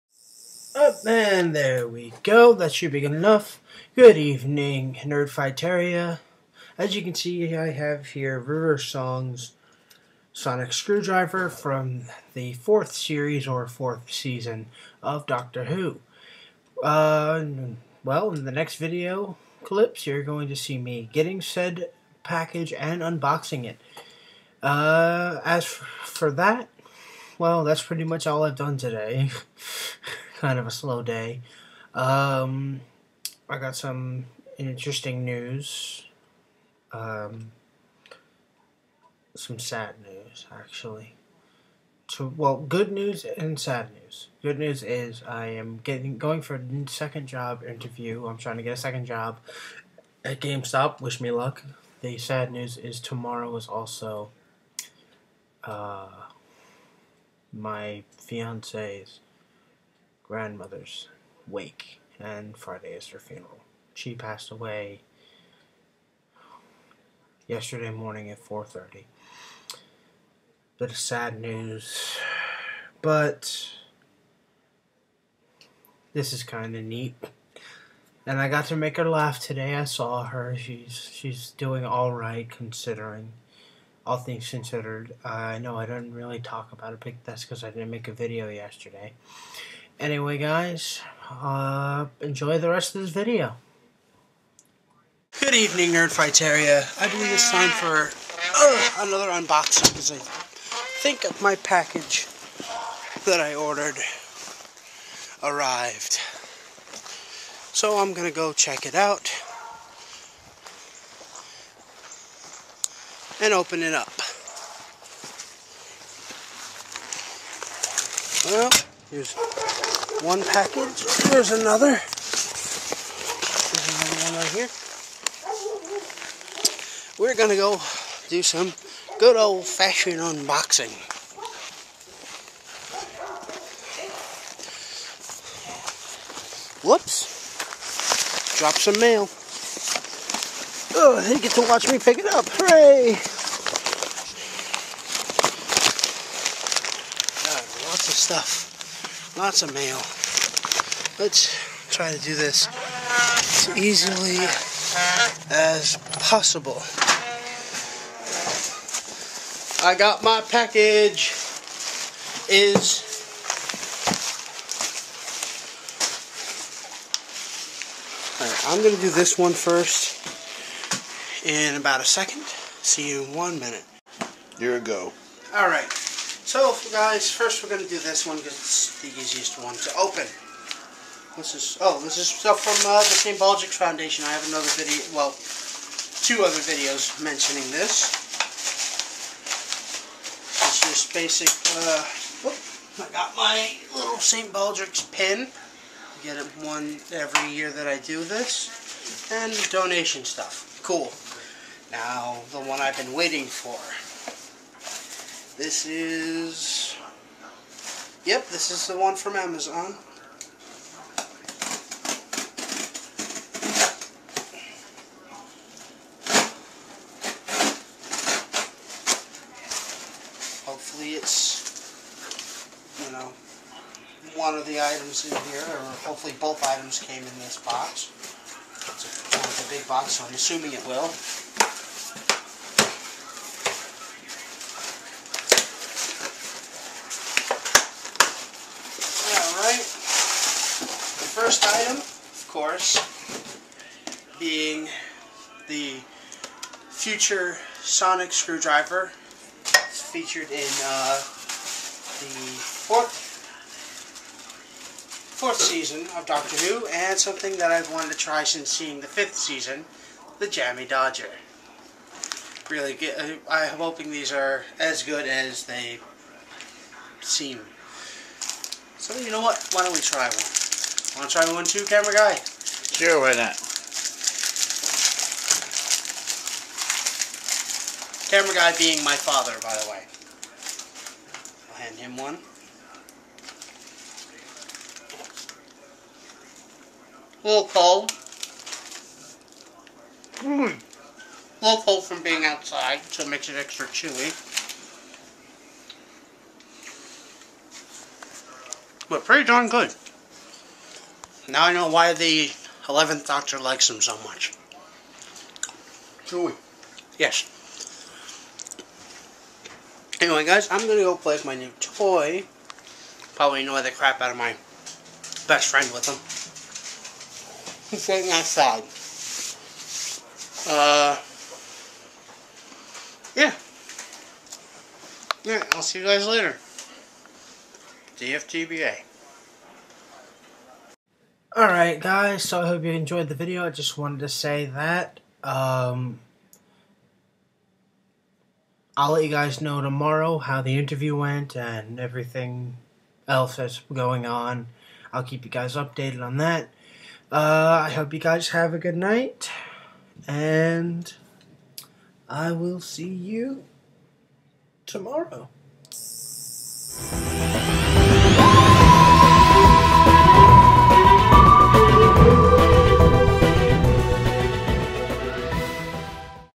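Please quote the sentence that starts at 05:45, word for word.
I'll keep you guys updated on that.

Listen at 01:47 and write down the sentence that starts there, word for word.
So I'm going to go check it out and open it up.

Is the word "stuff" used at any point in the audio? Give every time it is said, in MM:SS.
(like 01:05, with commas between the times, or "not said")
02:28, 03:02, 03:20.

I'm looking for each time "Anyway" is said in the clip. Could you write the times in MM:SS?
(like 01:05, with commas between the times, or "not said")
01:30, 05:10.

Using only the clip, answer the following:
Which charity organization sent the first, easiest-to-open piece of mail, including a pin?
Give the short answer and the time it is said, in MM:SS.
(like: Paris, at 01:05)
St. Baldrick's Foundation, at 03:03.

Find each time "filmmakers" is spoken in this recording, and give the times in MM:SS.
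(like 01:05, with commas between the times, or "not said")
not said.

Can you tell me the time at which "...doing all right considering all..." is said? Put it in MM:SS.
01:21.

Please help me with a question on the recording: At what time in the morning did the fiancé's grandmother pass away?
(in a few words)
4:30.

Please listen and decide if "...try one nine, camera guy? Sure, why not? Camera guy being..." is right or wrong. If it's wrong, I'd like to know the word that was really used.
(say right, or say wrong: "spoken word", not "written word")
wrong: "two", not "nine".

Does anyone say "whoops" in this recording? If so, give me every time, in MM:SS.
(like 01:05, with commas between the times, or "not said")
02:16, 03:12.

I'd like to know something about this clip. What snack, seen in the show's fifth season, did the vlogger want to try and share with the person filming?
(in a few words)
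Jammy Dodger.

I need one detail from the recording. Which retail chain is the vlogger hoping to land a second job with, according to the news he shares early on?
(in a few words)
GameStop.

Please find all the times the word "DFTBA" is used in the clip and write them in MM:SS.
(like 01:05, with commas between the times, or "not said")
05:28.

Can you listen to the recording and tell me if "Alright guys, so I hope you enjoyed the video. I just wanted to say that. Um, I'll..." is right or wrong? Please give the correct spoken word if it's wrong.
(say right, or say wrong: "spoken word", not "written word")
right.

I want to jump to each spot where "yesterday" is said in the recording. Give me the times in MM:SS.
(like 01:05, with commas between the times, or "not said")
01:07, 01:28.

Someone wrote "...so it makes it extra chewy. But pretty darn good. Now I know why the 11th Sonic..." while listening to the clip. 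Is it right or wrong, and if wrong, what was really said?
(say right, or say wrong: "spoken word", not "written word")
wrong: "Doctor", not "Sonic".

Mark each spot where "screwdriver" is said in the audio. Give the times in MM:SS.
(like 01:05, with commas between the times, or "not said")
00:10, 04:08.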